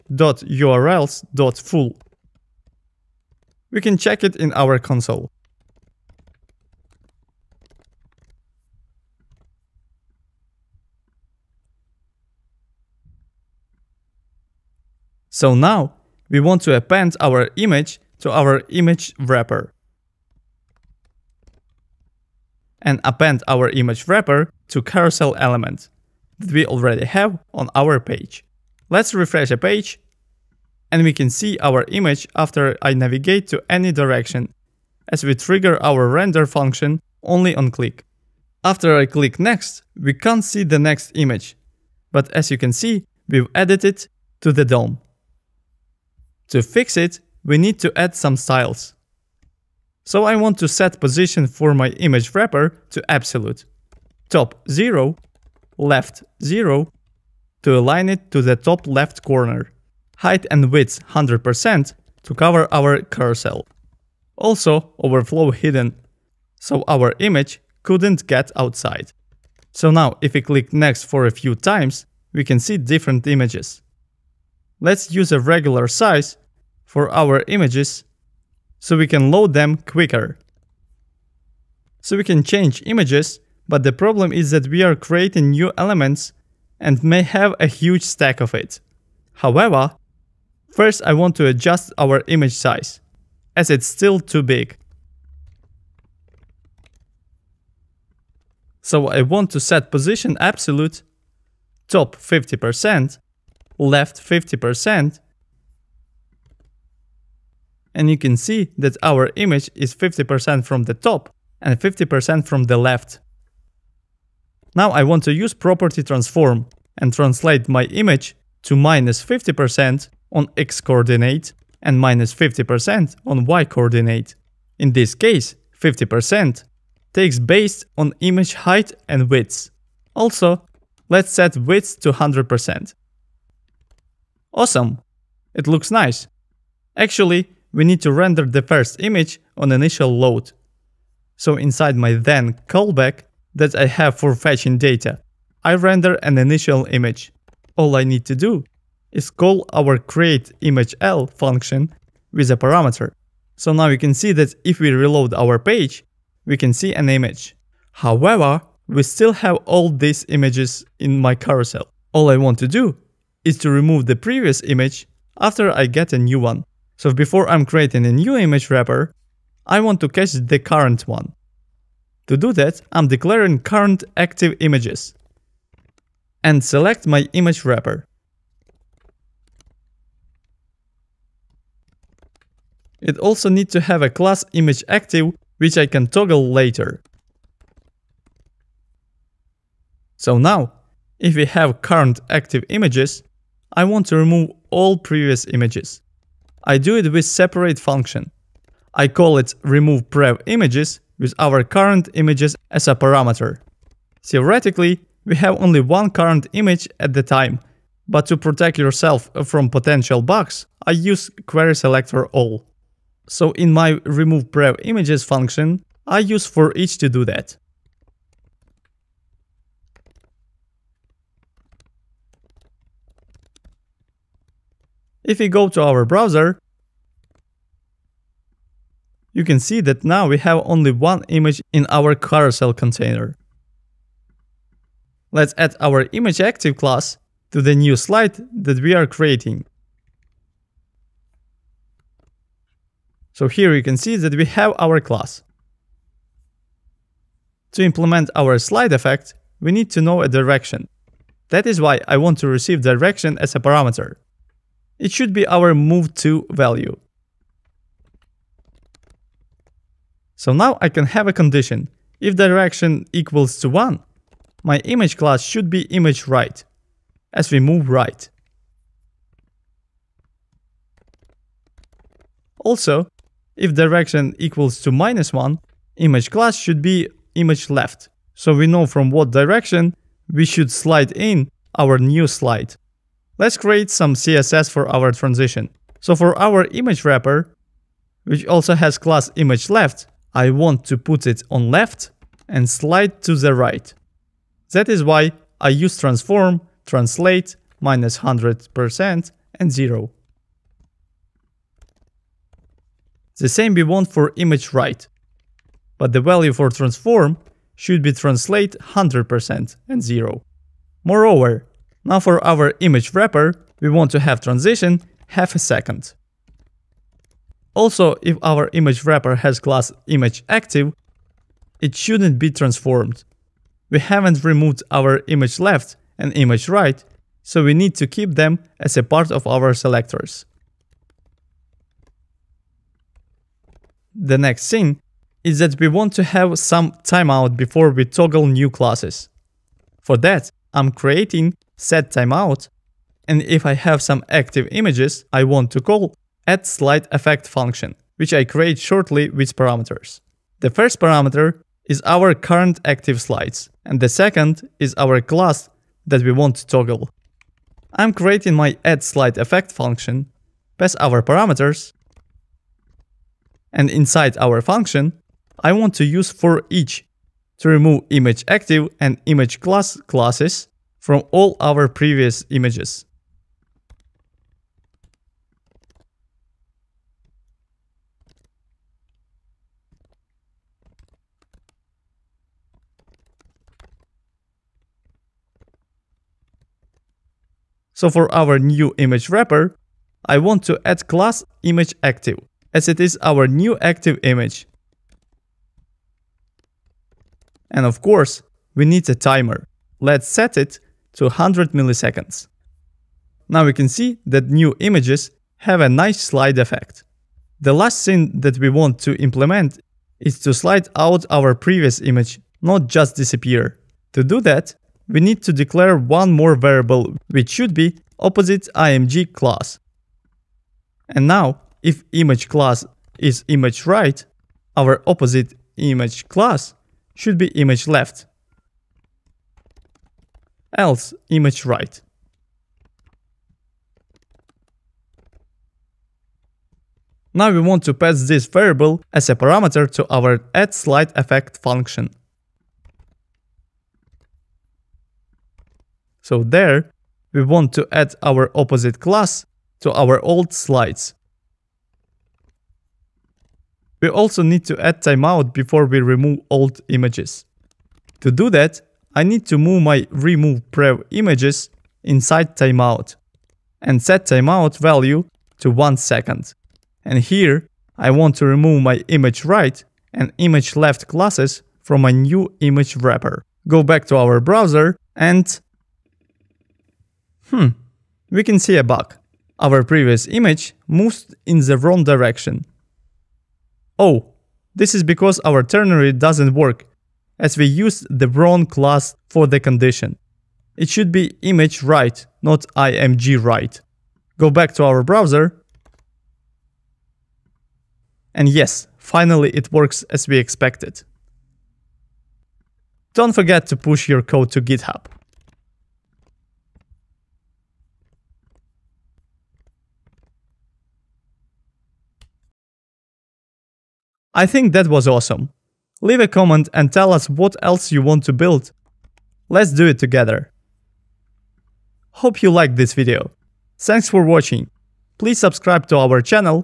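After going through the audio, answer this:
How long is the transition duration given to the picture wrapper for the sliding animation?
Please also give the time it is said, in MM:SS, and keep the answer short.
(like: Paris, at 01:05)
half a second, at 05:15.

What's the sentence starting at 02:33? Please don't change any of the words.
So now you can see that if we reload our page, we can see an image.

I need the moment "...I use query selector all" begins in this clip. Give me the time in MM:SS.
03:30.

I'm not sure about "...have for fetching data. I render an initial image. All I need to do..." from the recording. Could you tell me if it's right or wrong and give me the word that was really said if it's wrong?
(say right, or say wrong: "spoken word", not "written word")
right.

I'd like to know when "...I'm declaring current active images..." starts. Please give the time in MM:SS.
02:52.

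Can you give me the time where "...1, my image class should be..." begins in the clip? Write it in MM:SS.
04:23.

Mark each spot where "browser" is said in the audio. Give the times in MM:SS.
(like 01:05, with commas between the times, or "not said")
03:46, 07:54, 08:15.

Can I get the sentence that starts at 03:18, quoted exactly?
I call it remove prev images with our current images as a parameter.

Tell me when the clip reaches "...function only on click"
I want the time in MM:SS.
00:36.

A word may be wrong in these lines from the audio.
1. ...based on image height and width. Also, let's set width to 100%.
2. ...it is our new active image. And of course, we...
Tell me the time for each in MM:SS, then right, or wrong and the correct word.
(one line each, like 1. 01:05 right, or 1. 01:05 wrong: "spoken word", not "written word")
1. 02:07 right
2. 06:32 right.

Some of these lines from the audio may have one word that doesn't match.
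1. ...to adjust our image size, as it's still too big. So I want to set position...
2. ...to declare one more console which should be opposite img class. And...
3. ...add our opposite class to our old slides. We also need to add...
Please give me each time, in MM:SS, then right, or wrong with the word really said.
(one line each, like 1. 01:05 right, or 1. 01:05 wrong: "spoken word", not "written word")
1. 01:31 right
2. 06:55 wrong: "variable", not "console"
3. 07:27 right.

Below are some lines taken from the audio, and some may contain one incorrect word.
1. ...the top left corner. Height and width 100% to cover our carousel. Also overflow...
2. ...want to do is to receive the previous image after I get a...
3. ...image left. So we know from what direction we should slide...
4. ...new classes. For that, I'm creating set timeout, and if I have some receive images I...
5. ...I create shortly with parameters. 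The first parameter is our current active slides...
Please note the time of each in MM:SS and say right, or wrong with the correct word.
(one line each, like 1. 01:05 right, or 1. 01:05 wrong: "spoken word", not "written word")
1. 00:58 right
2. 02:42 wrong: "remove", not "receive"
3. 04:37 right
4. 05:38 wrong: "active", not "receive"
5. 05:48 right.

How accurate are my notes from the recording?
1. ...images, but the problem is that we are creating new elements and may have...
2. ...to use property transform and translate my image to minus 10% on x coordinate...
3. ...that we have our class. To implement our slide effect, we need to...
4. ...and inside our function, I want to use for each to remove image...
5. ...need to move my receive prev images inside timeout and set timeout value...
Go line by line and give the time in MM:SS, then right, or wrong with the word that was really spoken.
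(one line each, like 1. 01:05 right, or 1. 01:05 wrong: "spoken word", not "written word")
1. 01:22 right
2. 01:55 wrong: "50", not "10"
3. 04:04 right
4. 06:03 right
5. 07:39 wrong: "remove", not "receive".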